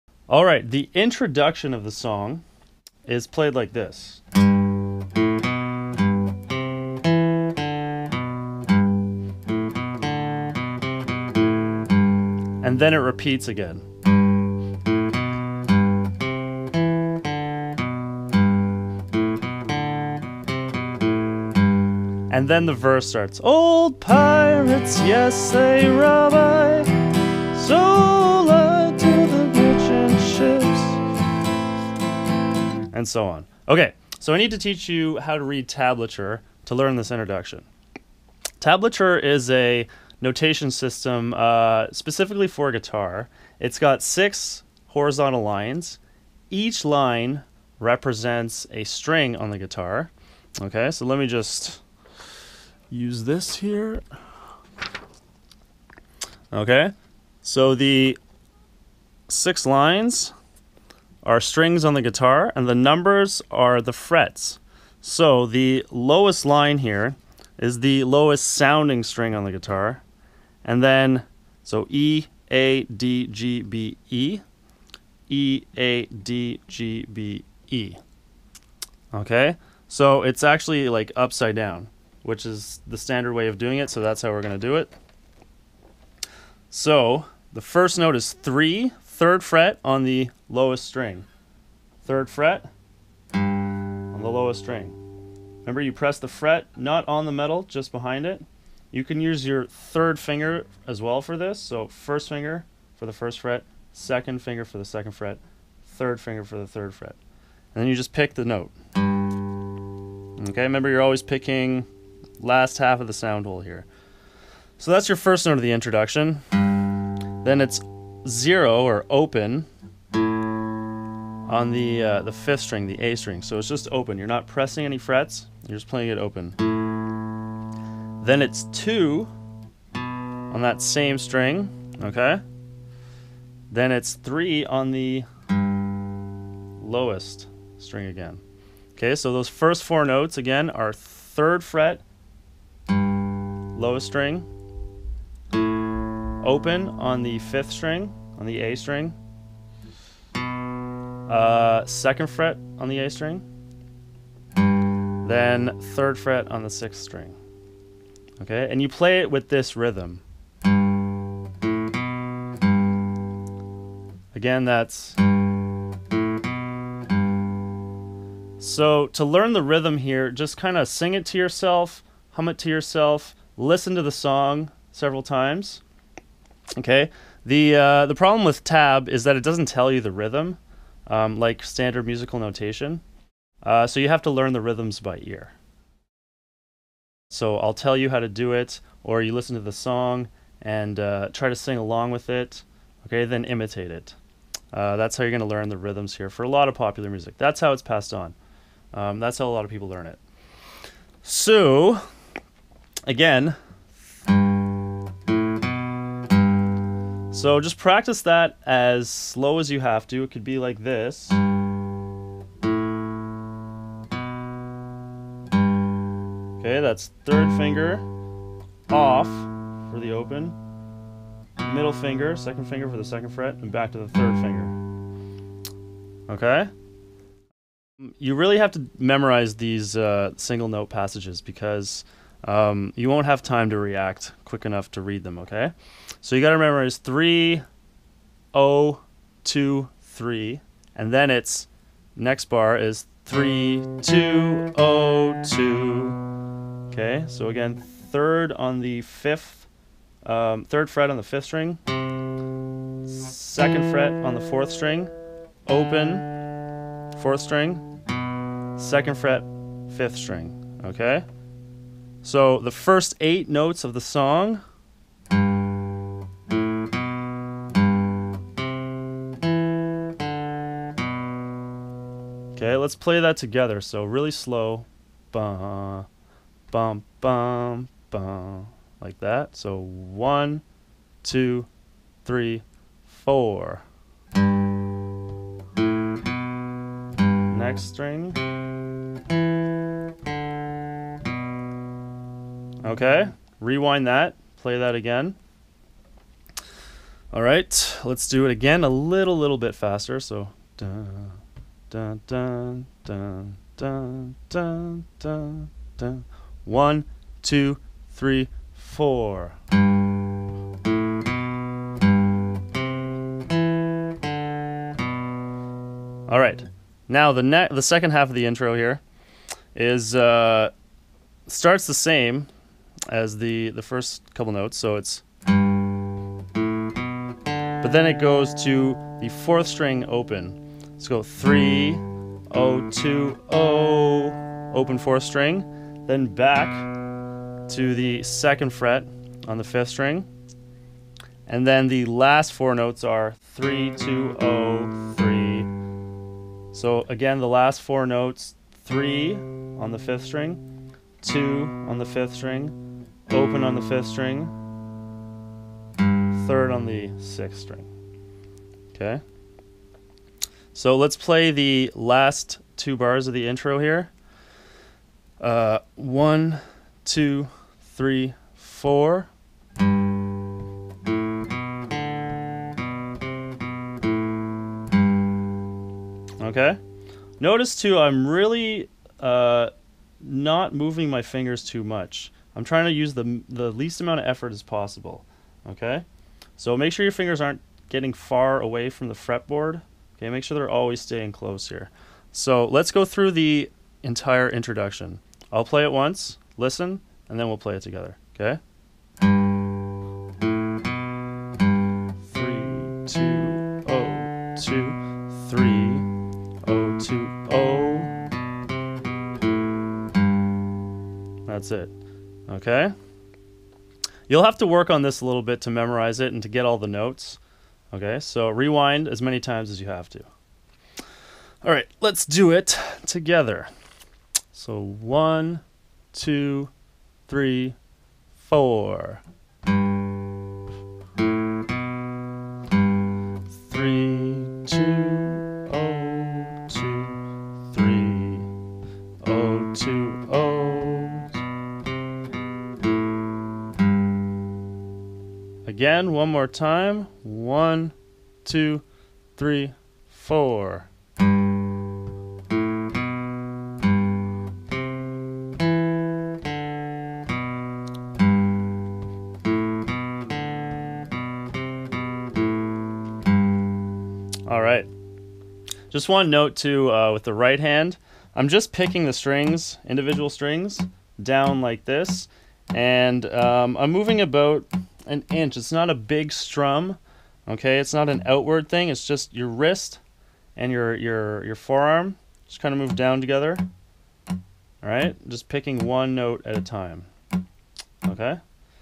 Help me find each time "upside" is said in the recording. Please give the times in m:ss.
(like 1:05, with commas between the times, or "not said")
1:21.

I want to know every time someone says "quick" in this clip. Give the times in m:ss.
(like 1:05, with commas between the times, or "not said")
3:54.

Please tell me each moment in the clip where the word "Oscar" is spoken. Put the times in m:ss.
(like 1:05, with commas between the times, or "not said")
not said.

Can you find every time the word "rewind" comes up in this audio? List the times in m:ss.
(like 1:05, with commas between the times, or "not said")
4:53, 6:58.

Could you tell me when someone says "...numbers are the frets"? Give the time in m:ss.
1:02.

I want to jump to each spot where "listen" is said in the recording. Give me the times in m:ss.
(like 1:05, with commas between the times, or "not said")
2:53, 3:09, 6:36.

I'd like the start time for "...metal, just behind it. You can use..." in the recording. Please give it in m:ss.
1:37.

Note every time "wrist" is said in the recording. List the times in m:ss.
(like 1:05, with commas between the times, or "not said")
7:59.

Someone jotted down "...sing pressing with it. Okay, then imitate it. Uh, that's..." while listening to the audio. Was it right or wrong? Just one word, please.
wrong.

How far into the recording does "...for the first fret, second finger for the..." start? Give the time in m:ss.
1:42.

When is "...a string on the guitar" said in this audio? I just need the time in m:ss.
0:48.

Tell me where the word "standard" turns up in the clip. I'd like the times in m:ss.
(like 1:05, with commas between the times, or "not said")
1:22, 3:01.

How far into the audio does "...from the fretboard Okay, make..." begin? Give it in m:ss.
6:28.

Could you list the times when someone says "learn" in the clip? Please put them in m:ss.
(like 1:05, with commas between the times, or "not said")
0:36, 2:49, 3:04, 3:15, 3:19.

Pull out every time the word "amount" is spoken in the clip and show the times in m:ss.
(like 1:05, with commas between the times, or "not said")
6:23.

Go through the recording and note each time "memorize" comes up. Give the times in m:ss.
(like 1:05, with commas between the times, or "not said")
3:48, 6:55.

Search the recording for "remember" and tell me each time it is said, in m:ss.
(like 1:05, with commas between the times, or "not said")
1:35, 1:50, 3:56.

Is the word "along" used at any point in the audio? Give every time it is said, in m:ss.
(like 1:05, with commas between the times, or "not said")
3:11.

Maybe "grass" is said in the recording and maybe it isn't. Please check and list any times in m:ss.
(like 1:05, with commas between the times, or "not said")
not said.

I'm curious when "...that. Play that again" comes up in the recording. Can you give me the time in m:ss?
4:54.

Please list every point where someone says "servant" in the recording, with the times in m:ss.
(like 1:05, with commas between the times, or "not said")
not said.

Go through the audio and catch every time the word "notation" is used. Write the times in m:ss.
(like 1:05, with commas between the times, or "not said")
0:40, 3:02.